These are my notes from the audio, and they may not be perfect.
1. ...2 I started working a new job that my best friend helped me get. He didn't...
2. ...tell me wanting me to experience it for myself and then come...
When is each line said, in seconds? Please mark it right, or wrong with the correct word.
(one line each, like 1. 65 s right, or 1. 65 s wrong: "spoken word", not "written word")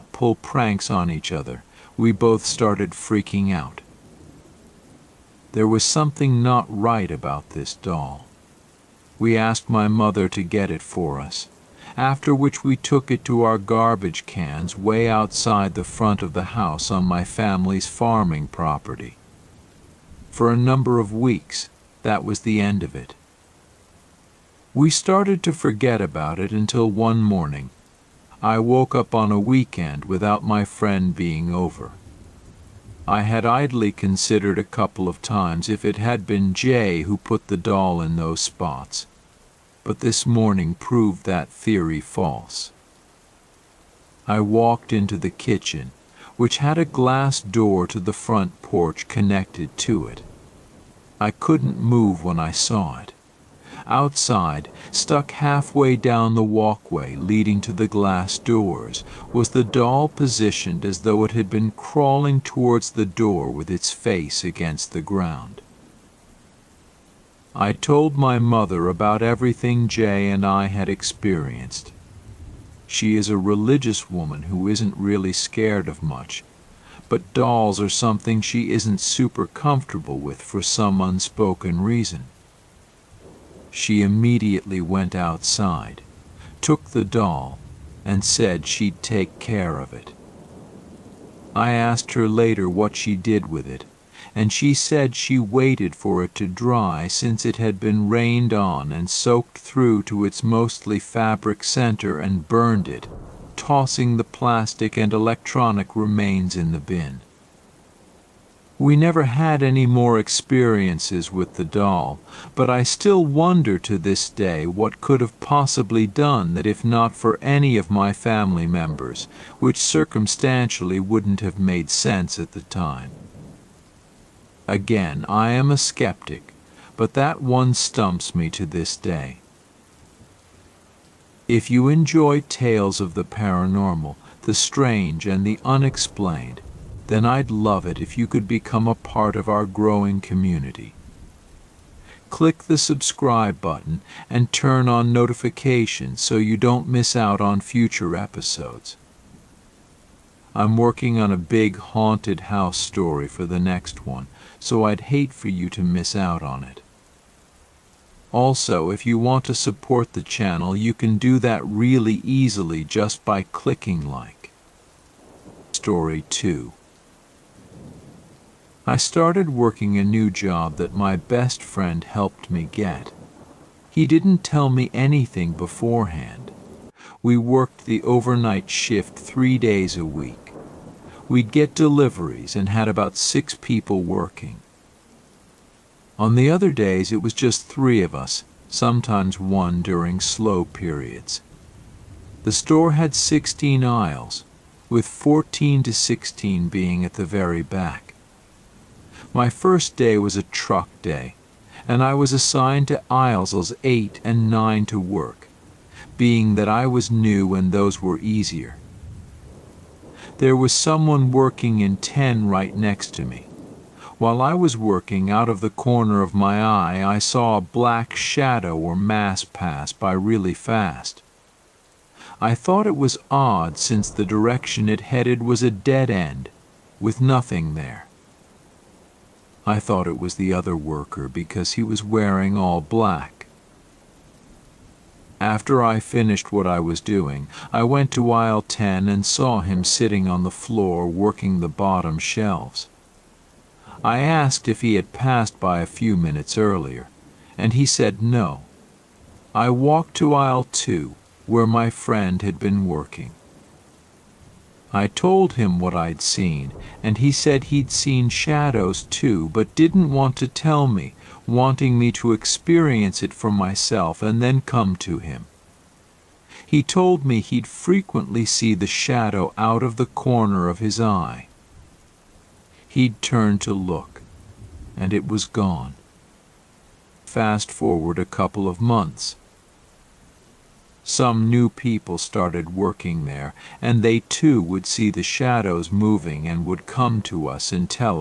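1. 166 s right
2. 260 s right.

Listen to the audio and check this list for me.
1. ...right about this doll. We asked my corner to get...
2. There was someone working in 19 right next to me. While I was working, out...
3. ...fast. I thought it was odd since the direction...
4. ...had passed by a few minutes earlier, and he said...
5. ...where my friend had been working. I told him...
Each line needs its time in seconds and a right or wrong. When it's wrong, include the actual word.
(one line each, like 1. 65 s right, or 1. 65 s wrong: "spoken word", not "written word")
1. 6 s wrong: "mother", not "corner"
2. 210 s wrong: "10", not "19"
3. 220 s right
4. 244 s right
5. 251 s right.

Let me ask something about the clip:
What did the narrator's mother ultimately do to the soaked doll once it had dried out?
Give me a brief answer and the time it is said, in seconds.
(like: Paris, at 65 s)
Burned it, at 102 s.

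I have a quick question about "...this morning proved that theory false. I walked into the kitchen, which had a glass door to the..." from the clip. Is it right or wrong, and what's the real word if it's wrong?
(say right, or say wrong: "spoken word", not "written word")
right.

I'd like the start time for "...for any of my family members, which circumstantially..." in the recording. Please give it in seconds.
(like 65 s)
117 s.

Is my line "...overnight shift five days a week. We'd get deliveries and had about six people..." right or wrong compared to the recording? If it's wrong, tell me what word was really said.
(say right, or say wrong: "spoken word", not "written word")
wrong: "three", not "five".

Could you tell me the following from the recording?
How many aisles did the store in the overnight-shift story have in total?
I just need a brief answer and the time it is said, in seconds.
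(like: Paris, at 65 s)
16, at 193 s.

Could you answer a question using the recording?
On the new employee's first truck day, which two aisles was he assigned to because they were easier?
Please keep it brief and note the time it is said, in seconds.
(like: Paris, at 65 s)
8 and 9, at 203 s.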